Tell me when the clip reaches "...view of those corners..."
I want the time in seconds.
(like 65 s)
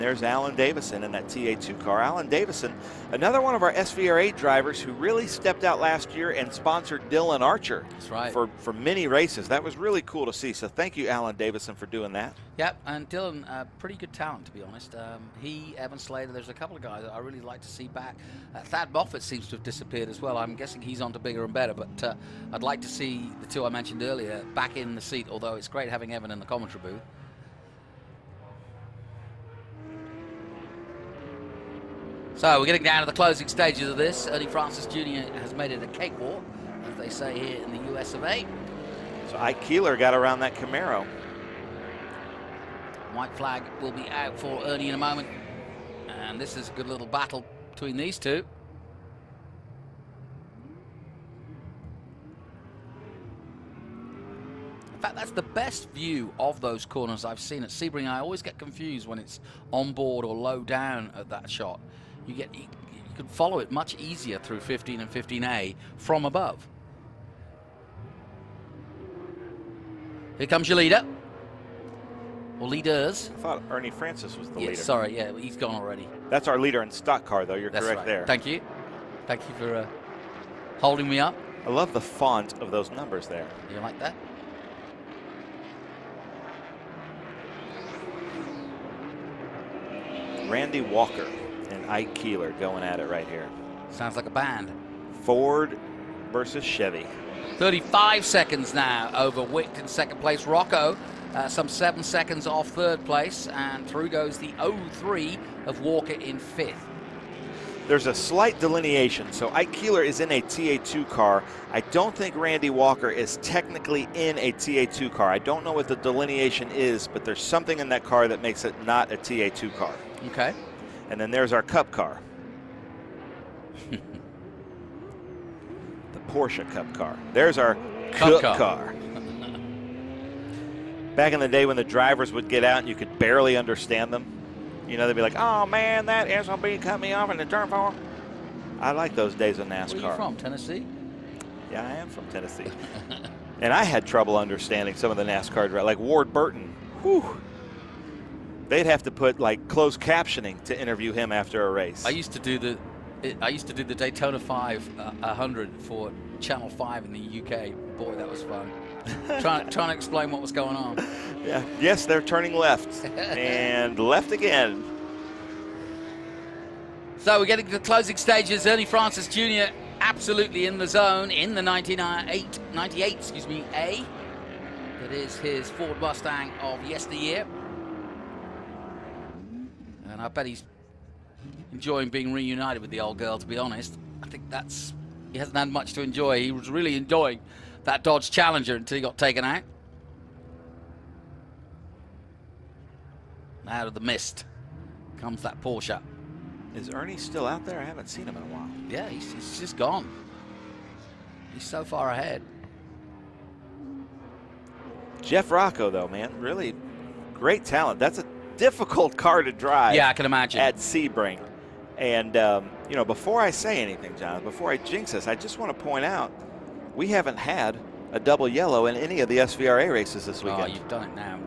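55 s.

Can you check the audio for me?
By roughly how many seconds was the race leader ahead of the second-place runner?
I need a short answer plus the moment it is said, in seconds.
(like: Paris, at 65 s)
35, at 97 s.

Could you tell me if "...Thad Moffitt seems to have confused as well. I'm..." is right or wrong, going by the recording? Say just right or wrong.
wrong.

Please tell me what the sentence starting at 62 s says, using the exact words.
You get you can follow it much easier through 15 and 15A from above.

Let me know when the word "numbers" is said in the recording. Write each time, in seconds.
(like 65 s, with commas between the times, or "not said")
82 s.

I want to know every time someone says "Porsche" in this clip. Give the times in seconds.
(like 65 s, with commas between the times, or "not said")
126 s, 195 s.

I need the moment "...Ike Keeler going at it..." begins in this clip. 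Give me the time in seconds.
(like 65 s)
91 s.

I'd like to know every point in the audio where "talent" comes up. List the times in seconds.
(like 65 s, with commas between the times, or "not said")
14 s, 207 s.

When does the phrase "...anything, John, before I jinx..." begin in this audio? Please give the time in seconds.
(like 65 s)
213 s.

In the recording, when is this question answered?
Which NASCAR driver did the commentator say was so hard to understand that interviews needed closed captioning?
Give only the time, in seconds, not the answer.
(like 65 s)
145 s.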